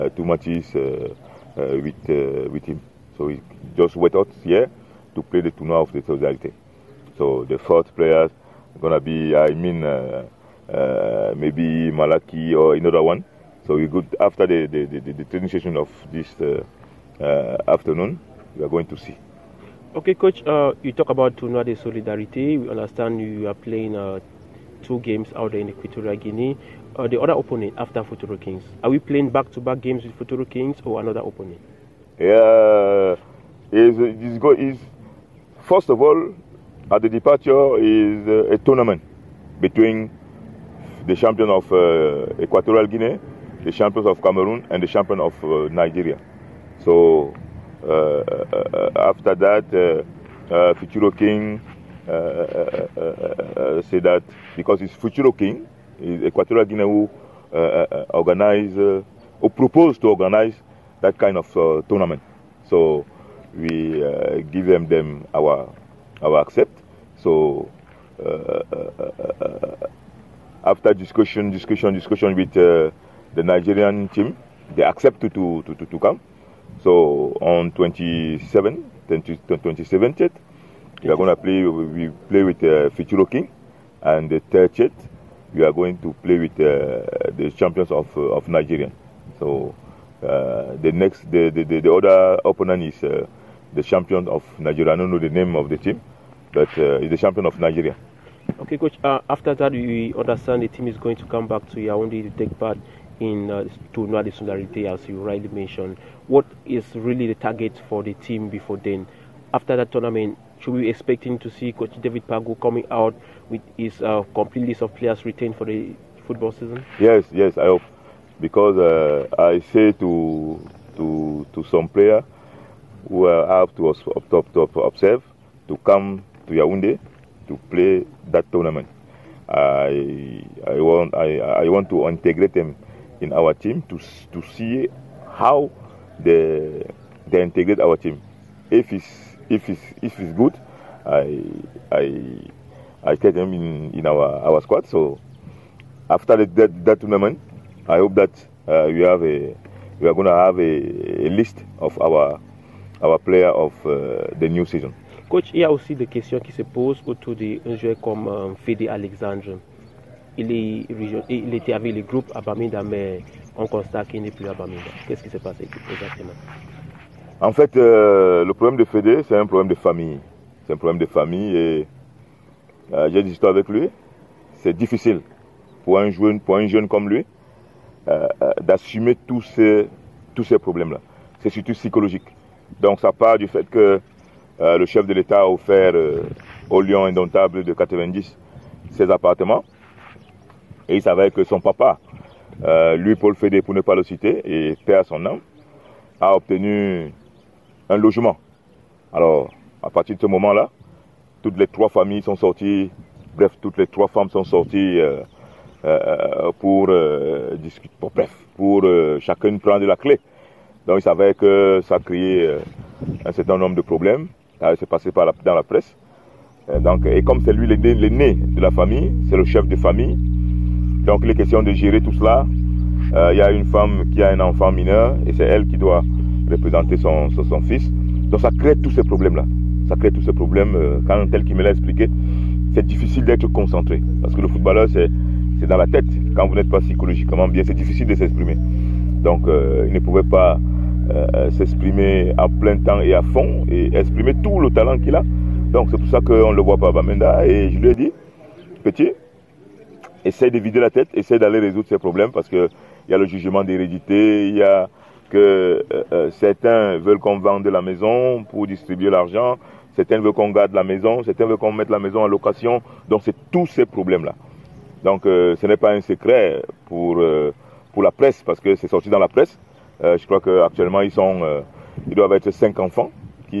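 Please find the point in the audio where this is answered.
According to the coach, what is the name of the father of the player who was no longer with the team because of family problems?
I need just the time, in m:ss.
3:13.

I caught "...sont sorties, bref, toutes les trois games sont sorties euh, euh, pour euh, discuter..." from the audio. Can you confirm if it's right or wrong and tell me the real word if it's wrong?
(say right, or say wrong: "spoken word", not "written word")
wrong: "femmes", not "games".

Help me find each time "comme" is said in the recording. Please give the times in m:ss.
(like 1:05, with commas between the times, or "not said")
2:38, 2:56, 3:37.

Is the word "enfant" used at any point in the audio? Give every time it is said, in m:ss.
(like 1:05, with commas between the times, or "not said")
3:44, 4:32.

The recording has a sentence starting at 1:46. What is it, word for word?
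What is really the target for the team before then?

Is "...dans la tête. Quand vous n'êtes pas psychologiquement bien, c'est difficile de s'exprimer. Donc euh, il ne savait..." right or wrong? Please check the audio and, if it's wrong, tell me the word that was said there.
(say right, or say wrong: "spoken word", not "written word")
wrong: "pouvait", not "savait".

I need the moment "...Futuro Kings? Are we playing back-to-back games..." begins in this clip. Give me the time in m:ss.
0:28.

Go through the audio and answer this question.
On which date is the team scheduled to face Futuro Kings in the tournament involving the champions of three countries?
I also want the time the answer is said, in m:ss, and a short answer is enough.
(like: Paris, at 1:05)
27th, at 1:19.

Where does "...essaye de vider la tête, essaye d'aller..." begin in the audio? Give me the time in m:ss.
4:10.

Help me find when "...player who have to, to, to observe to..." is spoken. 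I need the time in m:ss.
2:01.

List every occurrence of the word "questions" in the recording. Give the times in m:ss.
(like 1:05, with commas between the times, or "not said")
2:36, 3:41.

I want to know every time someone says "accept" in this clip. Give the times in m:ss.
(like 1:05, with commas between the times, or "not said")
1:06, 1:14.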